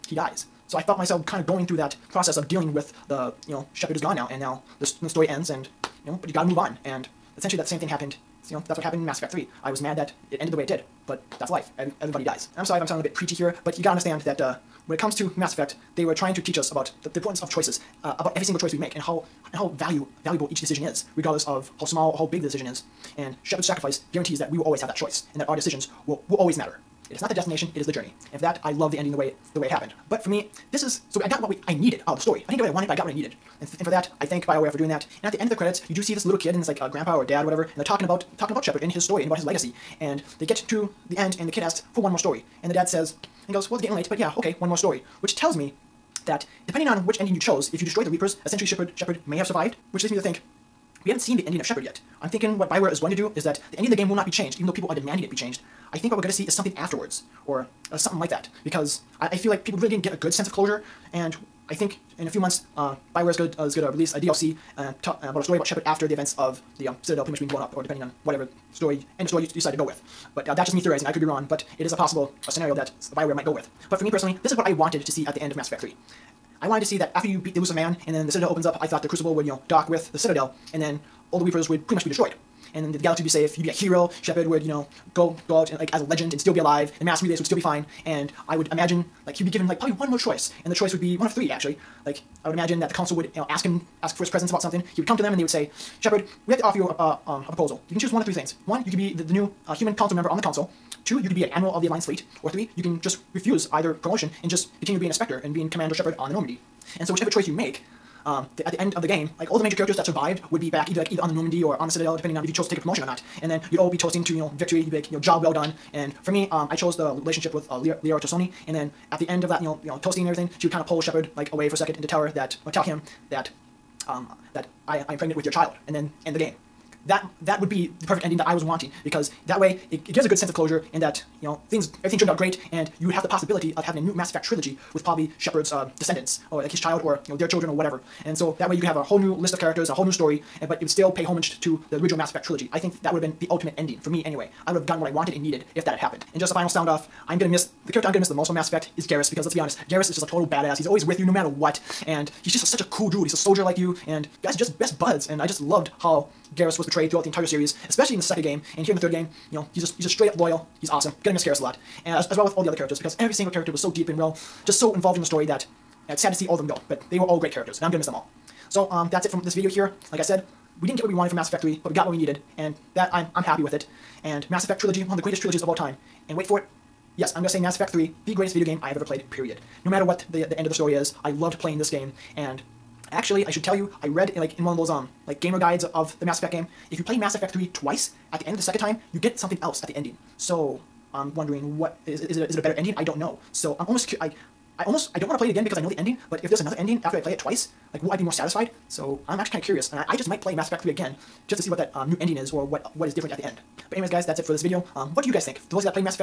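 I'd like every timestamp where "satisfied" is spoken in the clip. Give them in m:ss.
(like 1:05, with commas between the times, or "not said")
3:18.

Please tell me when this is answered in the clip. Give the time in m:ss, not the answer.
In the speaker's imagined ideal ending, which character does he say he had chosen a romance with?
1:57.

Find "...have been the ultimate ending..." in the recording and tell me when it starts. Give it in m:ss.
2:23.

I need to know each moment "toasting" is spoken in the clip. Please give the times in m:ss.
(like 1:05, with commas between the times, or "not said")
1:53, 2:00.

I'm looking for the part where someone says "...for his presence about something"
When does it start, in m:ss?
1:34.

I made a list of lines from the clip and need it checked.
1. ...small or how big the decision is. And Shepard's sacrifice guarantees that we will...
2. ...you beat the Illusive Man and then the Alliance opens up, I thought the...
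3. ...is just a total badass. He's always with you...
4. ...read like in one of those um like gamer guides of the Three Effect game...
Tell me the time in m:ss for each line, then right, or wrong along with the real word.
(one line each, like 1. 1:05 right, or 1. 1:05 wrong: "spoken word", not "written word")
1. 0:21 right
2. 1:17 wrong: "Citadel", not "Alliance"
3. 2:30 right
4. 3:04 wrong: "Mass", not "Three".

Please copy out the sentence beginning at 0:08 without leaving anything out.
You know, that's what happened in Mass Effect Three.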